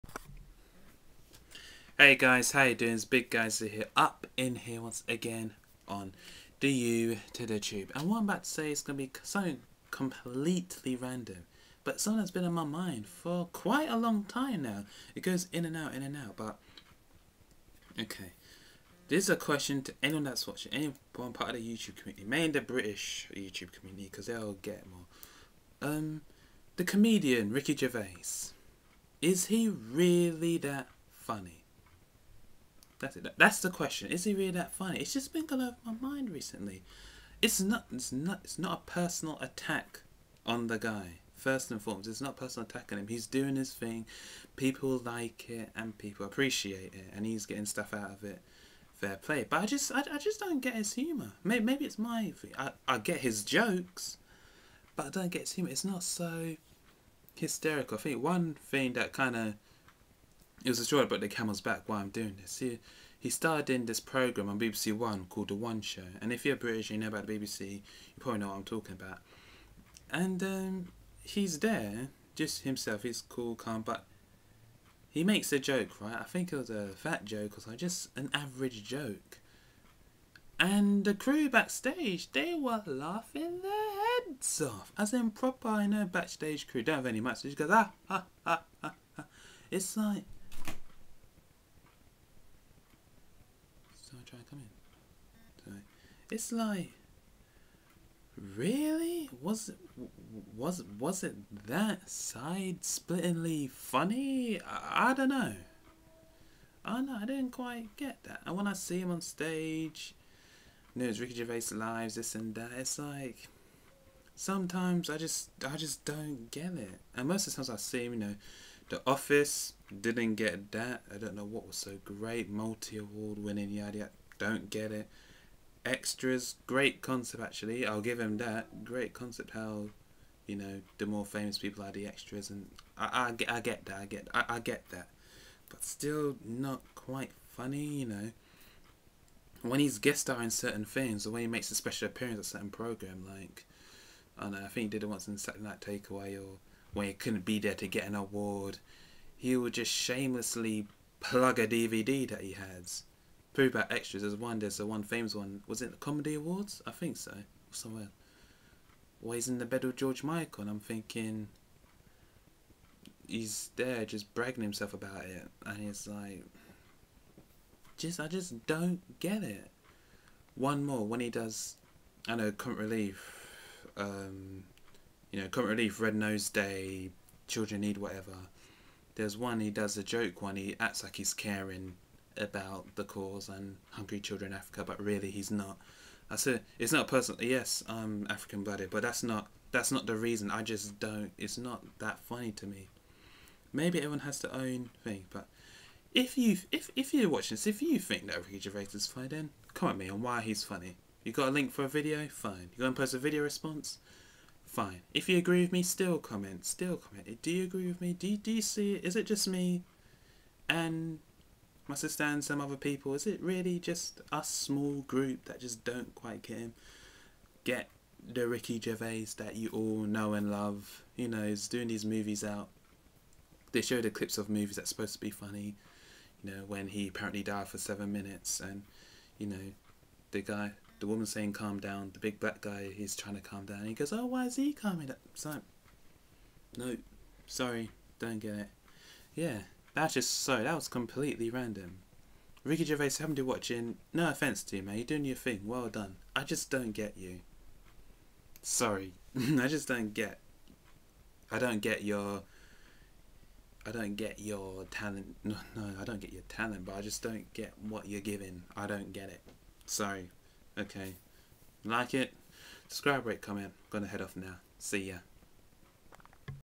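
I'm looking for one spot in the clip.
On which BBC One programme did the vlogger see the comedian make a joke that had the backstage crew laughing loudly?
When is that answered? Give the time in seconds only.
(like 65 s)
65 s.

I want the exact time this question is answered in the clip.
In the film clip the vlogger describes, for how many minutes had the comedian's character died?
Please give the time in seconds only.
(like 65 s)
227 s.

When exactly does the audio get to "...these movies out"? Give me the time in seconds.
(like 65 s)
221 s.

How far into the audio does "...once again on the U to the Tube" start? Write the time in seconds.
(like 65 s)
4 s.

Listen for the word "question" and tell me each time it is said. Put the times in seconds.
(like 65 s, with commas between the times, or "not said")
19 s, 33 s.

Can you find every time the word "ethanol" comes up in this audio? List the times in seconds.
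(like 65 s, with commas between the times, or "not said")
not said.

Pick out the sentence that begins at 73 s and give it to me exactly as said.
He's cool, calm, but he makes a joke, right?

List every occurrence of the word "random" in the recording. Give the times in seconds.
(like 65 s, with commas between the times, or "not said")
10 s, 241 s.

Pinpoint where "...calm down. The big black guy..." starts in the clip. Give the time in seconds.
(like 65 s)
231 s.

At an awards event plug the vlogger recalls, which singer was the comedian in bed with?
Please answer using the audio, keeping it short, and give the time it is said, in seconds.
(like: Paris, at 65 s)
George Michael, at 159 s.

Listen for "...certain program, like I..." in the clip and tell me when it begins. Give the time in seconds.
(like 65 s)
142 s.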